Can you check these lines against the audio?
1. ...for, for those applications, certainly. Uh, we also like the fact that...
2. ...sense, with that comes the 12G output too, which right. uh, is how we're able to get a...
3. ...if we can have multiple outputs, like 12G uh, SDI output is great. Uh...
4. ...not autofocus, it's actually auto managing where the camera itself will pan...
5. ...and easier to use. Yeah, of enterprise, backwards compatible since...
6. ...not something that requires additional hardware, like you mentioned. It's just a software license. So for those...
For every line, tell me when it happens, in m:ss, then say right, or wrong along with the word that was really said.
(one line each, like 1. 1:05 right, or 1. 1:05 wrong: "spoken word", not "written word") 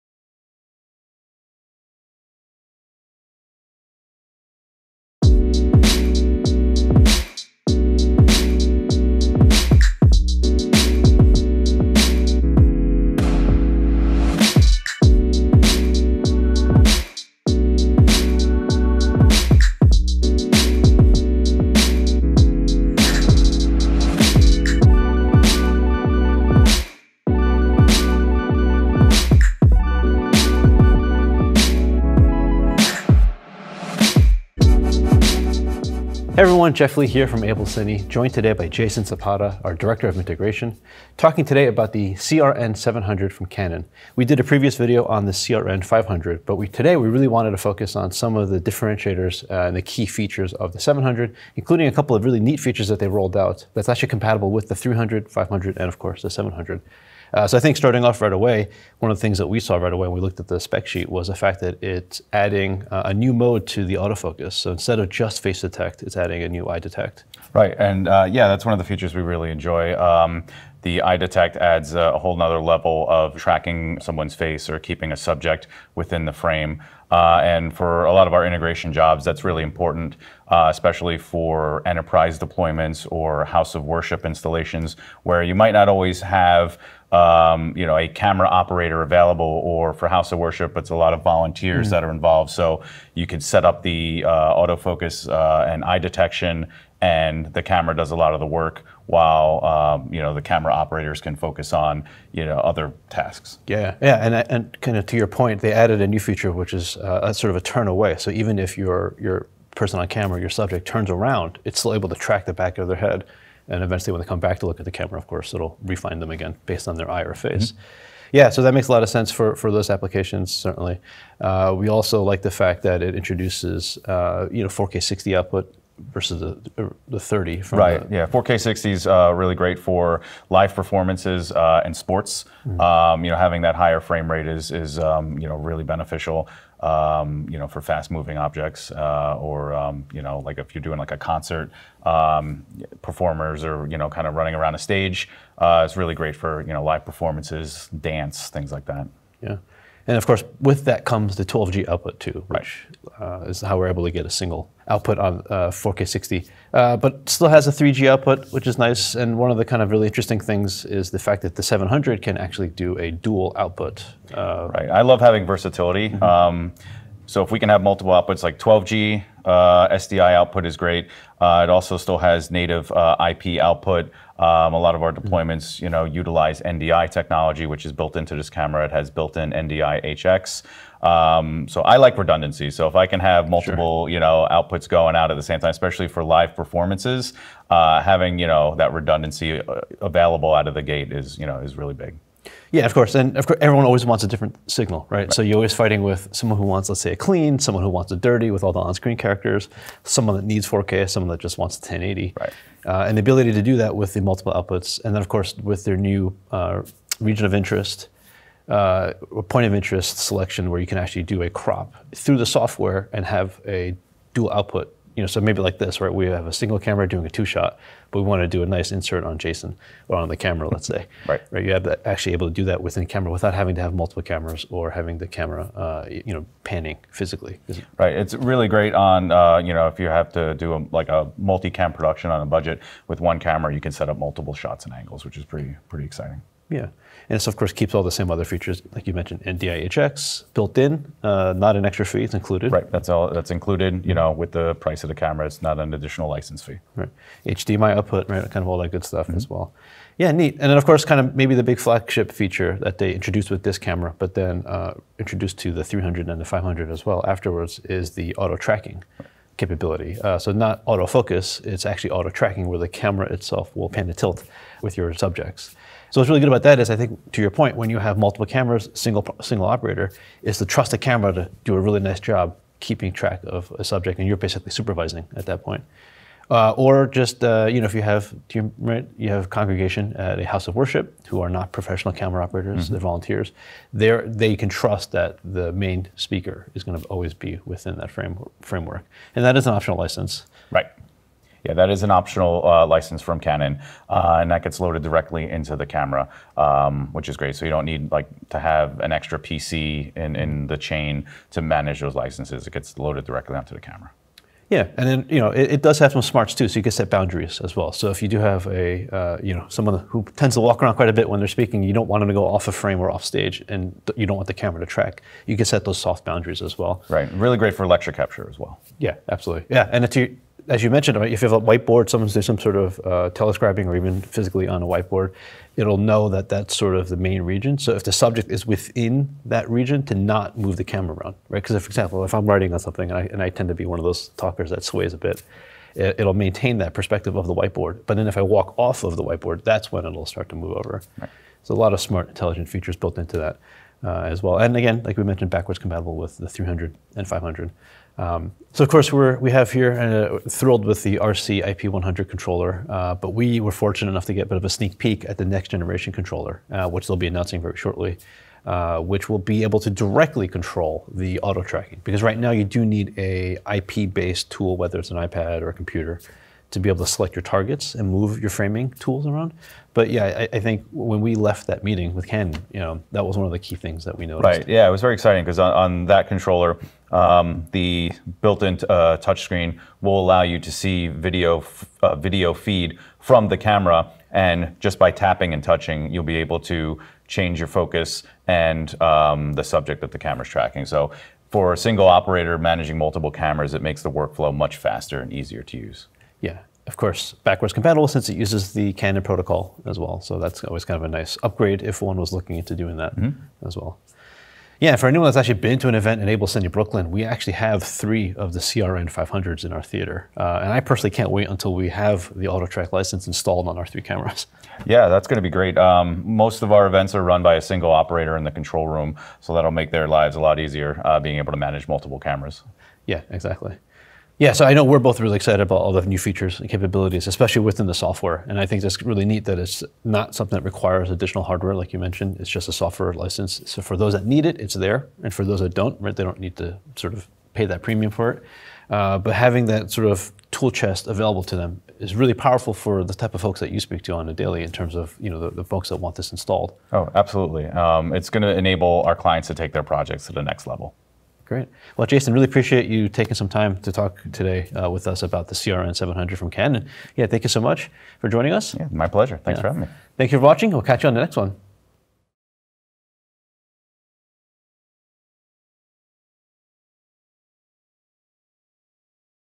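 1. 1:59 right
2. 2:30 wrong: "course", not "sense"
3. 2:47 right
4. 4:20 wrong: "tracking", not "managing"
5. 6:35 wrong: "course", not "enterprise"
6. 7:10 right.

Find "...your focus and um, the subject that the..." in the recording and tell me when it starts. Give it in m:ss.
6:27.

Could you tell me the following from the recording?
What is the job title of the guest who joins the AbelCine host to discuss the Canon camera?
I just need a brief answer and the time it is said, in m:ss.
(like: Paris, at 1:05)
Director of Integration, at 0:39.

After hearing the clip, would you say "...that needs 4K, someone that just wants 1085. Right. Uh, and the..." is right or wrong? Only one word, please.
wrong.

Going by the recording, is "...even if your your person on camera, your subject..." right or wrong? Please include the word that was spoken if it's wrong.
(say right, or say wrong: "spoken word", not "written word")
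right.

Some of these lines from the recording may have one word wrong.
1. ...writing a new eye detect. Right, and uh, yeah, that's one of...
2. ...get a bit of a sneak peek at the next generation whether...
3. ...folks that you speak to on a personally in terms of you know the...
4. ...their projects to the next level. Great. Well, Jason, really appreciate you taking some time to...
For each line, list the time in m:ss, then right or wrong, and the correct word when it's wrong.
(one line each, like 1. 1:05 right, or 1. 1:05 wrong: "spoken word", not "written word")
1. 1:06 wrong: "adding", not "writing"
2. 5:54 wrong: "controller", not "whether"
3. 7:23 wrong: "daily", not "personally"
4. 7:29 right.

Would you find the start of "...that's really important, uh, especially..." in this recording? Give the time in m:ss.
1:19.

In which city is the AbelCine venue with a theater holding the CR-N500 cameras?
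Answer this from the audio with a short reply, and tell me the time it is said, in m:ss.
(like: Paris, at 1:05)
Brooklyn, at 6:46.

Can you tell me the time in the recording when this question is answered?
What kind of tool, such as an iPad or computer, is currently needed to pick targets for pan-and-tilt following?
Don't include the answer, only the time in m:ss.
6:03.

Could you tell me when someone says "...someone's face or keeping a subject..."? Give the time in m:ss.
1:14.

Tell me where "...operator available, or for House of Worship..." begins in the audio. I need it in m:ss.
1:28.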